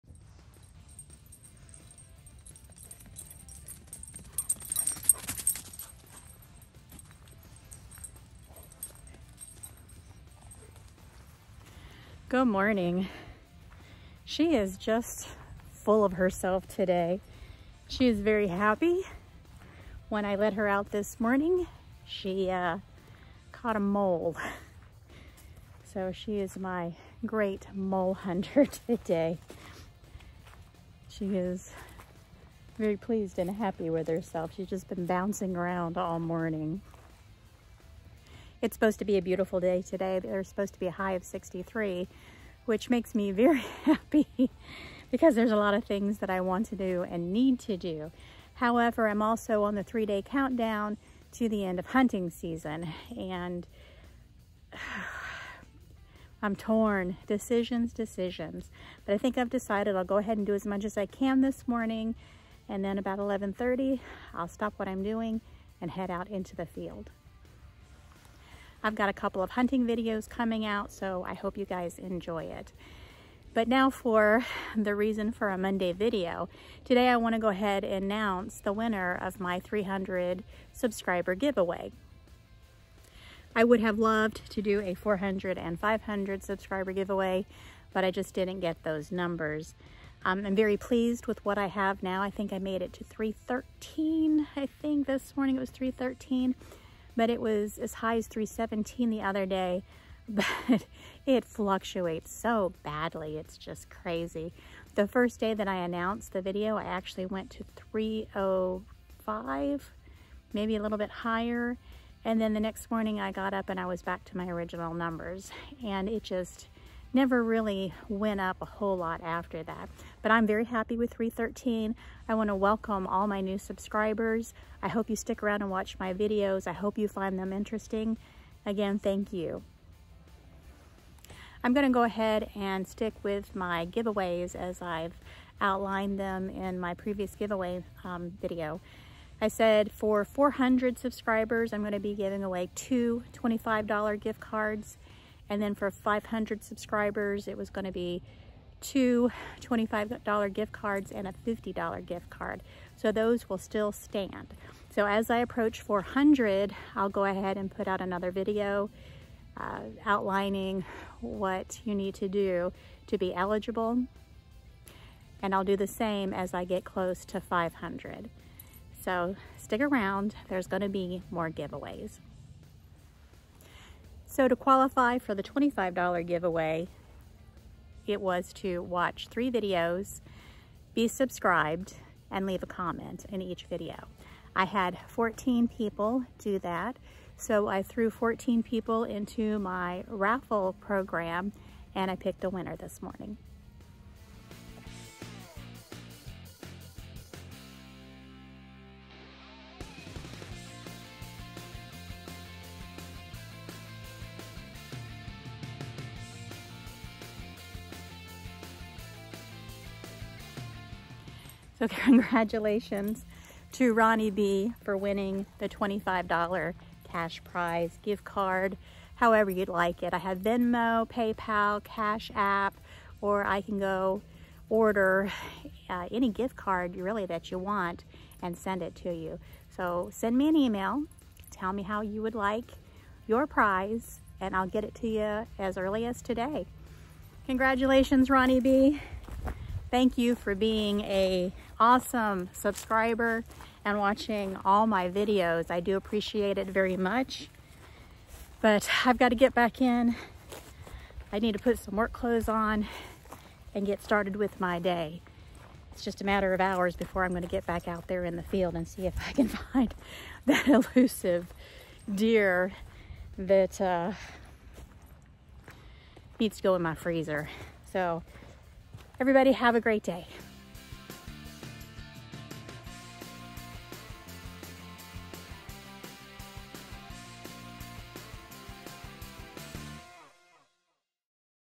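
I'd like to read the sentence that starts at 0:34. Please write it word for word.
She's just been bouncing around all morning.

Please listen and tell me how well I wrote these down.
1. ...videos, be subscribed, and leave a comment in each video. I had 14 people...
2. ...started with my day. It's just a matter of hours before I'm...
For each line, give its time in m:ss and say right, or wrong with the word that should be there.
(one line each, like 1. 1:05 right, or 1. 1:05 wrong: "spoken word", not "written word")
1. 2:59 right
2. 4:14 right.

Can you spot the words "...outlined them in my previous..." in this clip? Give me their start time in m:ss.
2:15.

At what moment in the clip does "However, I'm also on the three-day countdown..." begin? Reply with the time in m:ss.
0:48.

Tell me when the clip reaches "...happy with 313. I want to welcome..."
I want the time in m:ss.
2:00.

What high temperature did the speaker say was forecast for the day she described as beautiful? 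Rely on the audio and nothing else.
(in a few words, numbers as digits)
63.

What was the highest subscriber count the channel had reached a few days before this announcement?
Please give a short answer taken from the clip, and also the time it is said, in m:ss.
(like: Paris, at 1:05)
317, at 1:38.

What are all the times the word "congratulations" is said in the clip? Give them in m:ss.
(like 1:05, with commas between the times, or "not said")
3:31, 3:57.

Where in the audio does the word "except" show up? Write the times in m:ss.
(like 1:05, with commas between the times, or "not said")
not said.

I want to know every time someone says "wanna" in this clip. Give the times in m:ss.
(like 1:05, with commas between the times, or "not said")
1:17.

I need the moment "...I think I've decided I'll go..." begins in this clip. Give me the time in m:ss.
0:59.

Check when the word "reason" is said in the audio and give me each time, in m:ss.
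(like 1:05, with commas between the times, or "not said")
1:14.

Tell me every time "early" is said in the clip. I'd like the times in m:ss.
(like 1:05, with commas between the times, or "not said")
3:55.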